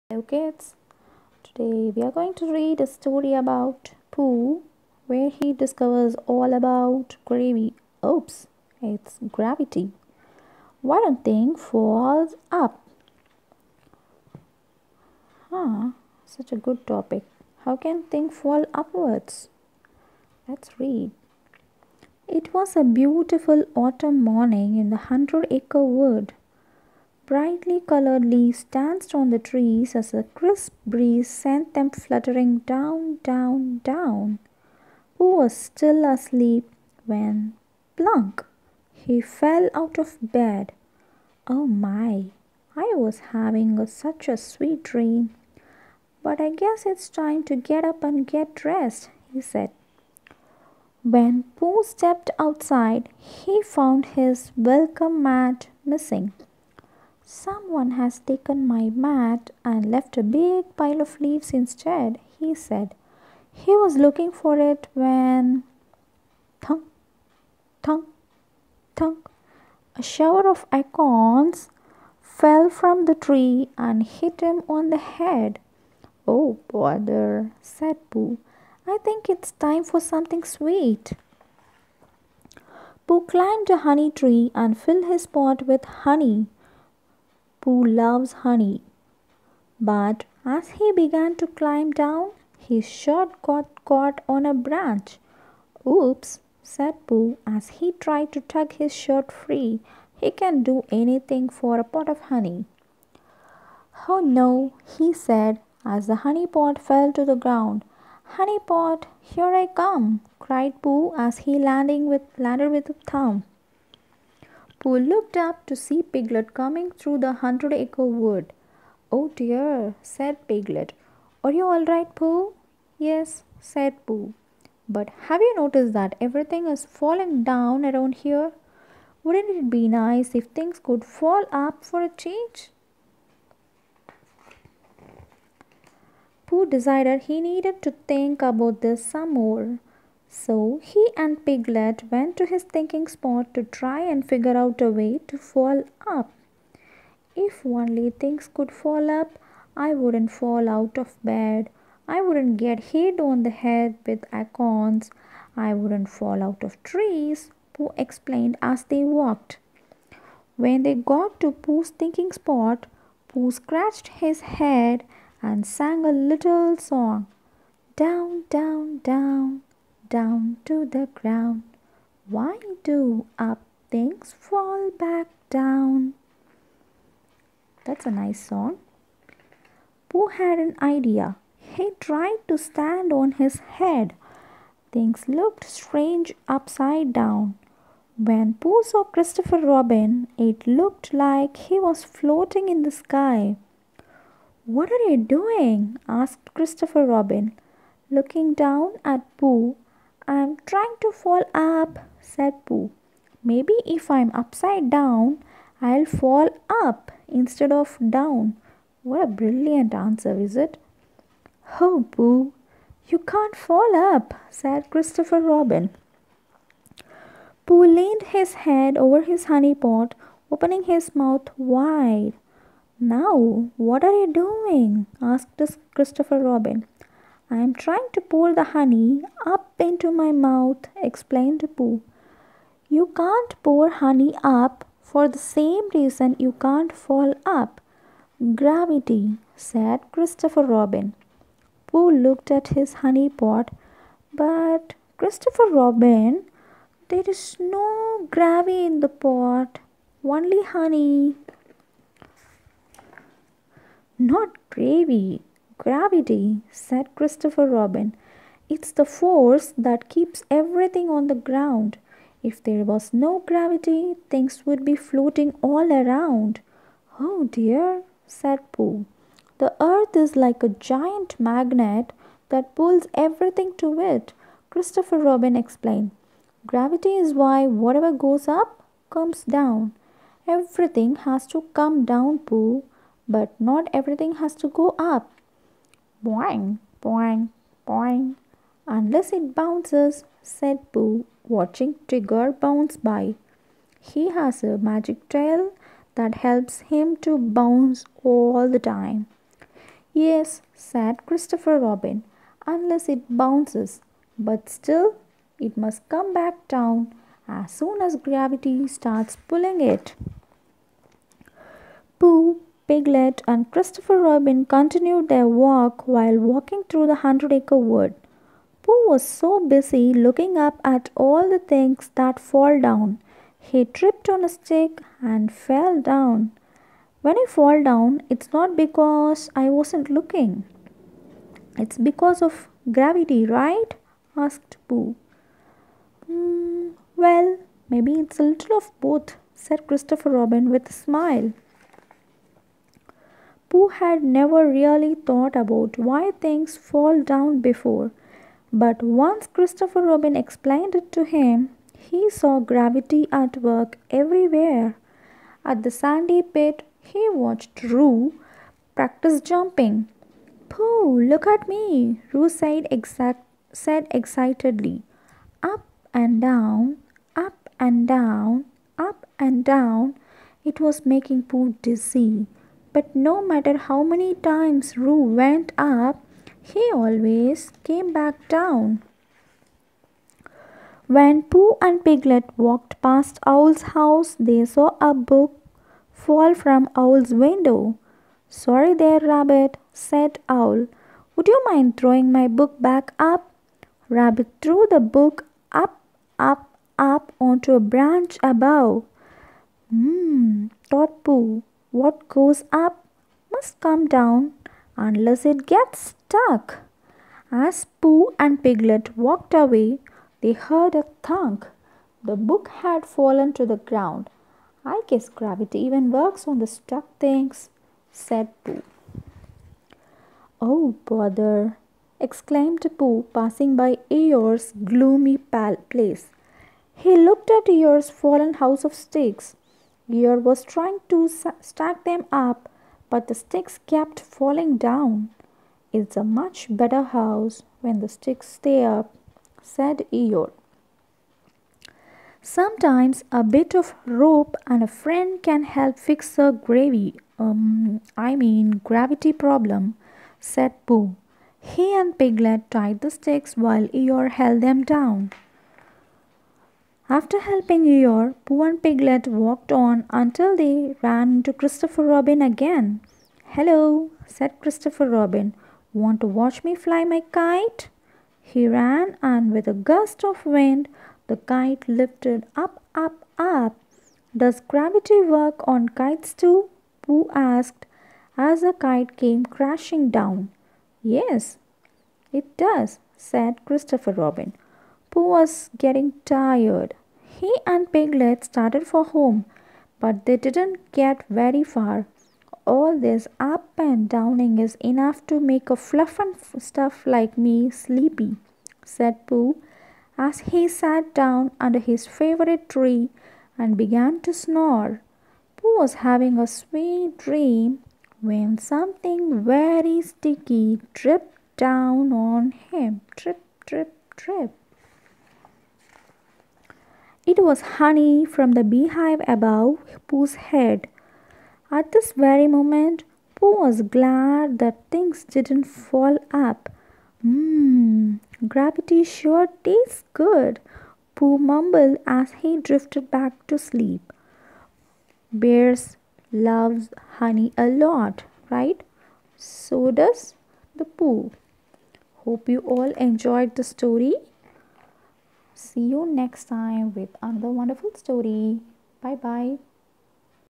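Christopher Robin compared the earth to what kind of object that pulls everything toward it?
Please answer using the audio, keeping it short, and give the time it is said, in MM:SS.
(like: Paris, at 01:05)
A giant magnet, at 04:30.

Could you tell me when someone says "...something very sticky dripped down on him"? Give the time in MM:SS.
08:28.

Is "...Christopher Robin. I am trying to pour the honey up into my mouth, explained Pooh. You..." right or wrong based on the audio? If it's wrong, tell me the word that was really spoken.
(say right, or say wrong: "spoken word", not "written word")
right.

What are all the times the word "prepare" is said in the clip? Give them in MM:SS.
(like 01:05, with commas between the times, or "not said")
not said.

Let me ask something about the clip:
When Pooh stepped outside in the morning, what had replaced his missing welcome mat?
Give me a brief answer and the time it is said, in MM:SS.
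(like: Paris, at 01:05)
A big pile of leaves, at 01:00.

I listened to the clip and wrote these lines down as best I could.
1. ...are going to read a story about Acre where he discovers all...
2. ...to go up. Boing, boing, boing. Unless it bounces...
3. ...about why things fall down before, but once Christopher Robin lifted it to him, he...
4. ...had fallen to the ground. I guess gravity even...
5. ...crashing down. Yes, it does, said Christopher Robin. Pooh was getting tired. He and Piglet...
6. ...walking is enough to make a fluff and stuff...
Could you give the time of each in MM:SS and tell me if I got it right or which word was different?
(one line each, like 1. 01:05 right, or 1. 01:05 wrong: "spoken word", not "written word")
1. 00:02 wrong: "Pooh", not "Acre"
2. 04:44 right
3. 05:45 wrong: "explained", not "lifted"
4. 06:52 right
5. 07:59 right
6. 08:14 wrong: "downing", not "walking".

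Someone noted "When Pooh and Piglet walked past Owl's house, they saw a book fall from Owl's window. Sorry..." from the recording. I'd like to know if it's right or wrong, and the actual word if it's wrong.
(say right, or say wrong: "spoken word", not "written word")
right.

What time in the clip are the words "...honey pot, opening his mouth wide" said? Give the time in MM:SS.
03:39.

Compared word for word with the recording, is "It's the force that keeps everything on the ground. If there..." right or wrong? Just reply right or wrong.
right.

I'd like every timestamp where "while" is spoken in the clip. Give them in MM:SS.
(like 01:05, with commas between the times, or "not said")
05:16, 07:33.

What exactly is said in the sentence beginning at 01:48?
Honey pot, here I come, cried Pooh as he landing with, landed with a thump.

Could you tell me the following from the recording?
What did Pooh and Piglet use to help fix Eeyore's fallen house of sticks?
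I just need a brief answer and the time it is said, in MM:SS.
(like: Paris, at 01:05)
Rope, at 07:24.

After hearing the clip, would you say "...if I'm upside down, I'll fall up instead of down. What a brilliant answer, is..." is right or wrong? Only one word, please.
right.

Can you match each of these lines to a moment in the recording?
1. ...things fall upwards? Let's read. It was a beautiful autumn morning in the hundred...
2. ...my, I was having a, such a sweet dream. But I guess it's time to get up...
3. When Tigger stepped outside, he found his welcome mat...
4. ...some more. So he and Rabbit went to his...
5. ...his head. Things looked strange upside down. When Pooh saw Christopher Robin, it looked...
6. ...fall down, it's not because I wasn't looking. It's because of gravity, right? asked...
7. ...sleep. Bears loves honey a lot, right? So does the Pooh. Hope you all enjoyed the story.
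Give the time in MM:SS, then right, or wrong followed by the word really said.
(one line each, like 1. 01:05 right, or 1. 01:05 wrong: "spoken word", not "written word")
1. 00:18 right
2. 00:41 right
3. 00:51 wrong: "Pooh", not "Tigger"
4. 02:19 wrong: "Piglet", not "Rabbit"
5. 03:03 right
6. 05:27 right
7. 08:53 right.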